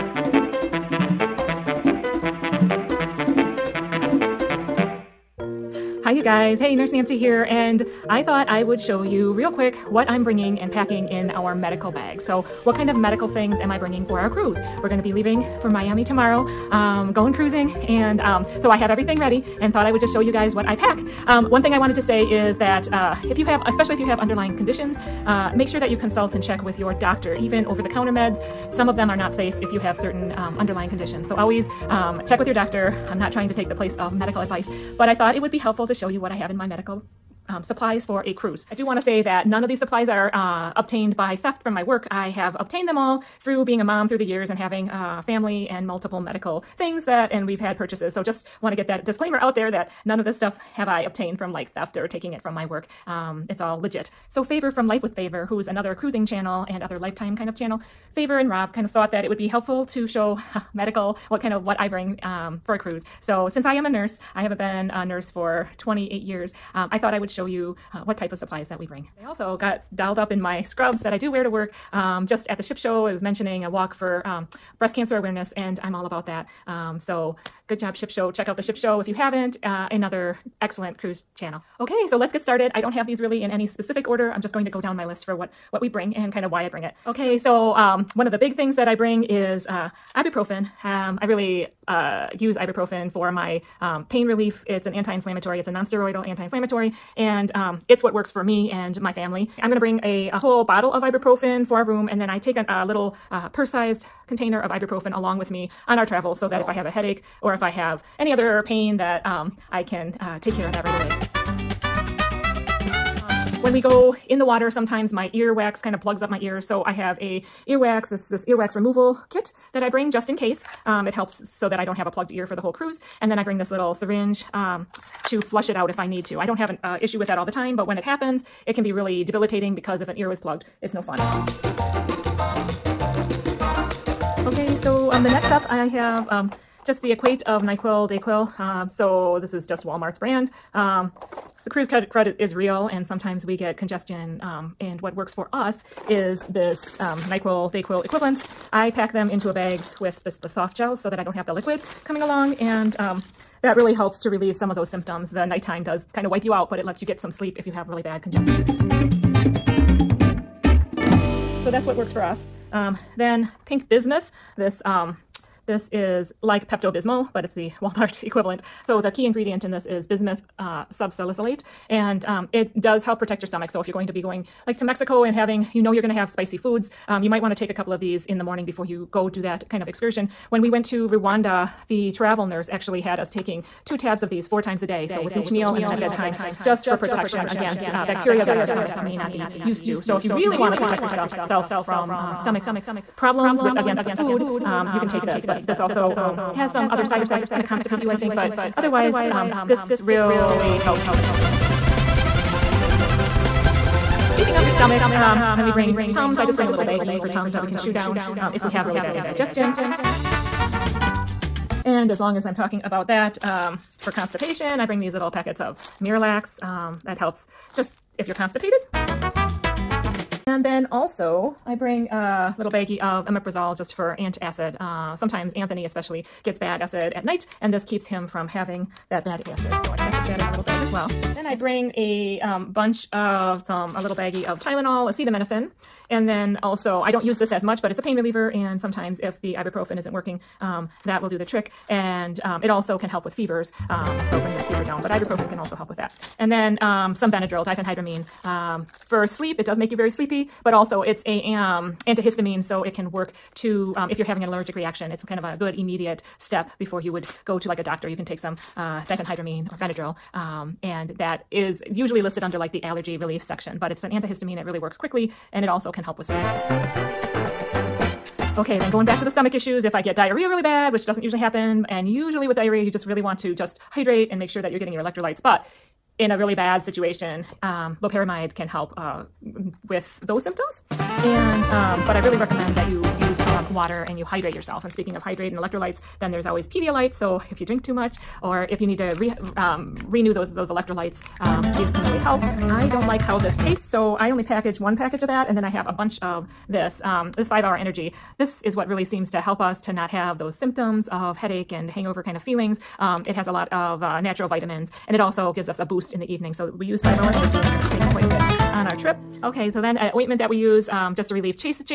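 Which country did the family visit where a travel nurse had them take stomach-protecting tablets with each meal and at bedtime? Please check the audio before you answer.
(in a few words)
Rwanda.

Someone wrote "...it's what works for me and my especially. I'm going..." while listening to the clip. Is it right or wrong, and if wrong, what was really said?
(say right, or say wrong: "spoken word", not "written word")
wrong: "family", not "especially".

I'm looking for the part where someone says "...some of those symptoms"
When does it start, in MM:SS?
02:34.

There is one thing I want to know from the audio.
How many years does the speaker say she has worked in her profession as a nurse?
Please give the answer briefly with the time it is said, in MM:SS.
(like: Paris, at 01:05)
28, at 01:05.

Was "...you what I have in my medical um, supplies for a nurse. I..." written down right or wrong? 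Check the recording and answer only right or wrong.
wrong.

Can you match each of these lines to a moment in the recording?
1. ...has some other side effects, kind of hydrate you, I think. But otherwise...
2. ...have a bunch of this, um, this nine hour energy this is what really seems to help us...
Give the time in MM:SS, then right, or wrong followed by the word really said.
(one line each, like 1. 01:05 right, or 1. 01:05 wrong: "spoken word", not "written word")
1. 03:16 wrong: "constipate", not "hydrate"
2. 04:55 wrong: "five", not "nine".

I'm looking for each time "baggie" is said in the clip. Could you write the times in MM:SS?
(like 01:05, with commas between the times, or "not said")
03:26, 03:42, 03:54.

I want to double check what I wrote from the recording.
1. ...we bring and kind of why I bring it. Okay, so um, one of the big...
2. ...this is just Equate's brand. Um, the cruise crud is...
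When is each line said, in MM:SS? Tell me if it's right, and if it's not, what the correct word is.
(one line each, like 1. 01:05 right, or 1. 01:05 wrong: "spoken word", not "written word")
1. 01:25 right
2. 02:19 wrong: "Walmart", not "Equate".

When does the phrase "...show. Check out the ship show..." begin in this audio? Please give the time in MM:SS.
01:18.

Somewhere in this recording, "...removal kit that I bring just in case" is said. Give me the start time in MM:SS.
01:58.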